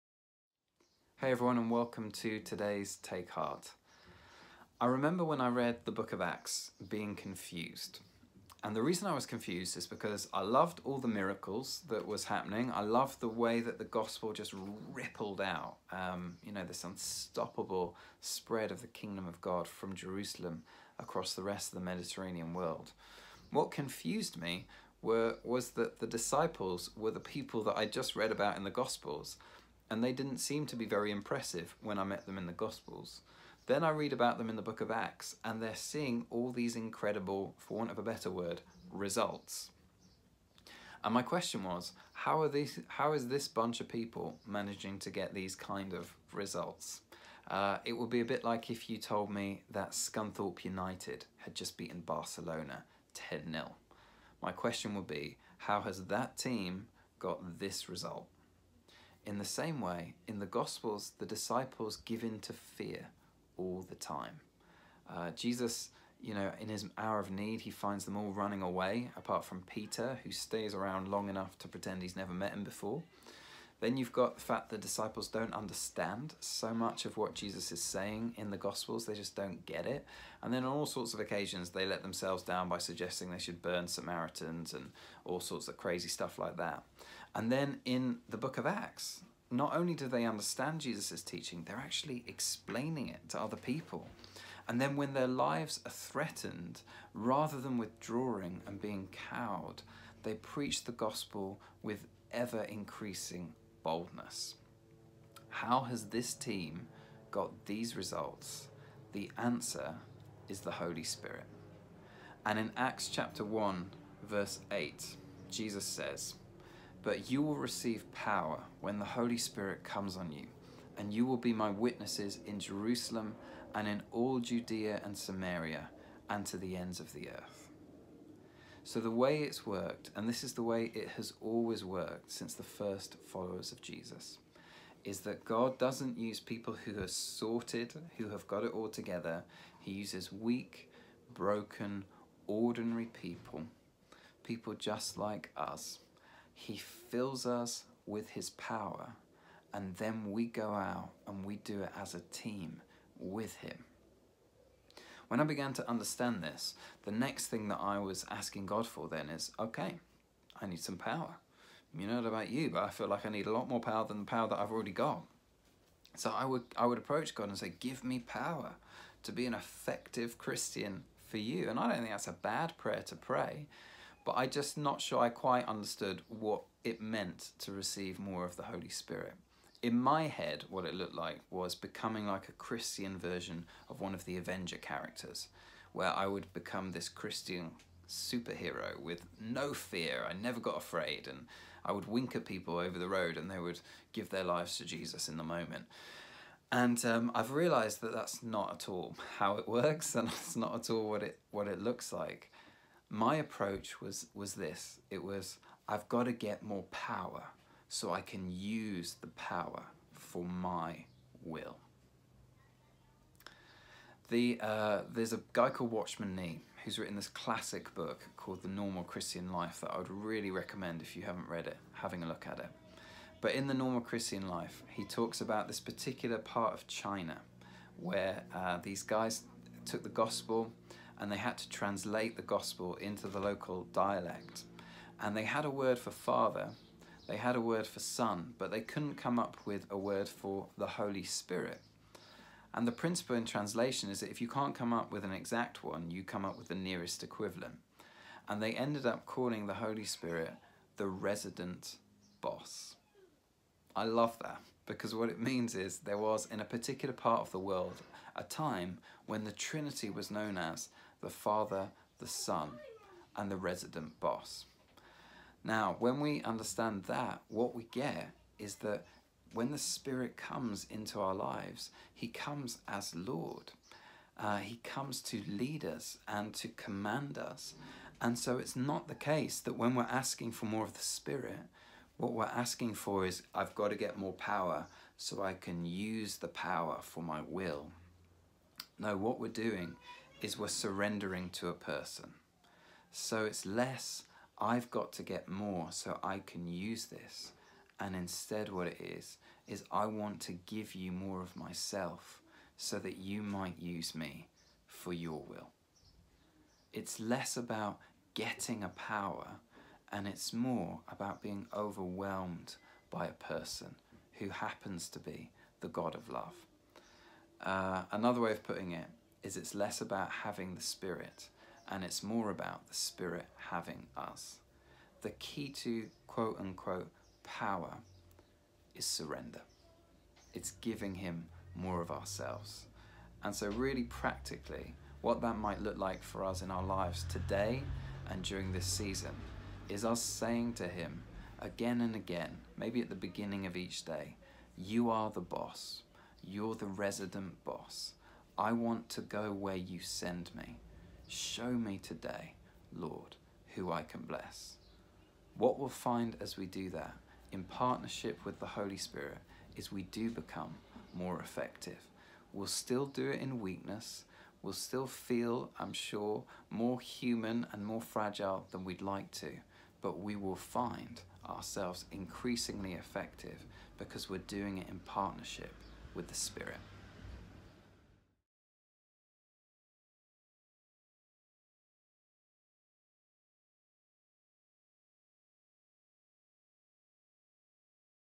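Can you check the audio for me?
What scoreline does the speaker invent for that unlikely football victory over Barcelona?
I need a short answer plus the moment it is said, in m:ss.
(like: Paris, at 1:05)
10-0, at 0:53.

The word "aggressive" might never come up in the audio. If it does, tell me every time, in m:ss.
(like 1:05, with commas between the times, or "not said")
not said.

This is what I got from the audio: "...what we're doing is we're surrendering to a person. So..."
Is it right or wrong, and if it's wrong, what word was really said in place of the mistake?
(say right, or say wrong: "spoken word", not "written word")
right.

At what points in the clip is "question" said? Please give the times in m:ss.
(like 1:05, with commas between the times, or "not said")
0:41, 0:54.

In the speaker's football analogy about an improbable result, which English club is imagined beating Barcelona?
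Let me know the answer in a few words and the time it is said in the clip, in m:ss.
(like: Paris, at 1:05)
Scunthorpe United, at 0:49.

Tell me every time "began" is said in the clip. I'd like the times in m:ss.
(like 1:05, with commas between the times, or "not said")
2:35.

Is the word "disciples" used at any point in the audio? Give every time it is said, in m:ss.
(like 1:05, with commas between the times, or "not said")
0:26, 1:01, 1:14.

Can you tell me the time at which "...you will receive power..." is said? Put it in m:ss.
1:57.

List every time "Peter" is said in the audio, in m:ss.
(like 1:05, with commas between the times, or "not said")
1:09.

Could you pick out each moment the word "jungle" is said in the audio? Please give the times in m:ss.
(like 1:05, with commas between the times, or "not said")
not said.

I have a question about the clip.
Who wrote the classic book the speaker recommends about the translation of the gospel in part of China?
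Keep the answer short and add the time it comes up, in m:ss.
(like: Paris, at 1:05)
Watchman Nee, at 3:35.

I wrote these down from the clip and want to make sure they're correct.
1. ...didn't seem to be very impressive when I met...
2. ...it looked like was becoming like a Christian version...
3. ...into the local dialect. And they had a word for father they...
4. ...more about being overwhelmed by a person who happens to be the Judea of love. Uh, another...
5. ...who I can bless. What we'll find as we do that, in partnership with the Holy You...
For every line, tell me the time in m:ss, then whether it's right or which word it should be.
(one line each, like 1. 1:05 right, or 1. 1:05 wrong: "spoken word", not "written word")
1. 0:30 right
2. 3:00 right
3. 3:52 right
4. 5:10 wrong: "God", not "Judea"
5. 5:53 wrong: "Spirit", not "You".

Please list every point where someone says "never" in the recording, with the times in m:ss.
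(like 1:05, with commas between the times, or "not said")
1:12, 3:10.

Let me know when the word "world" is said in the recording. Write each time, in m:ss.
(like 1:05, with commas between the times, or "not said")
0:22, 4:17.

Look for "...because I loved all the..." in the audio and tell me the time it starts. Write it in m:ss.
0:09.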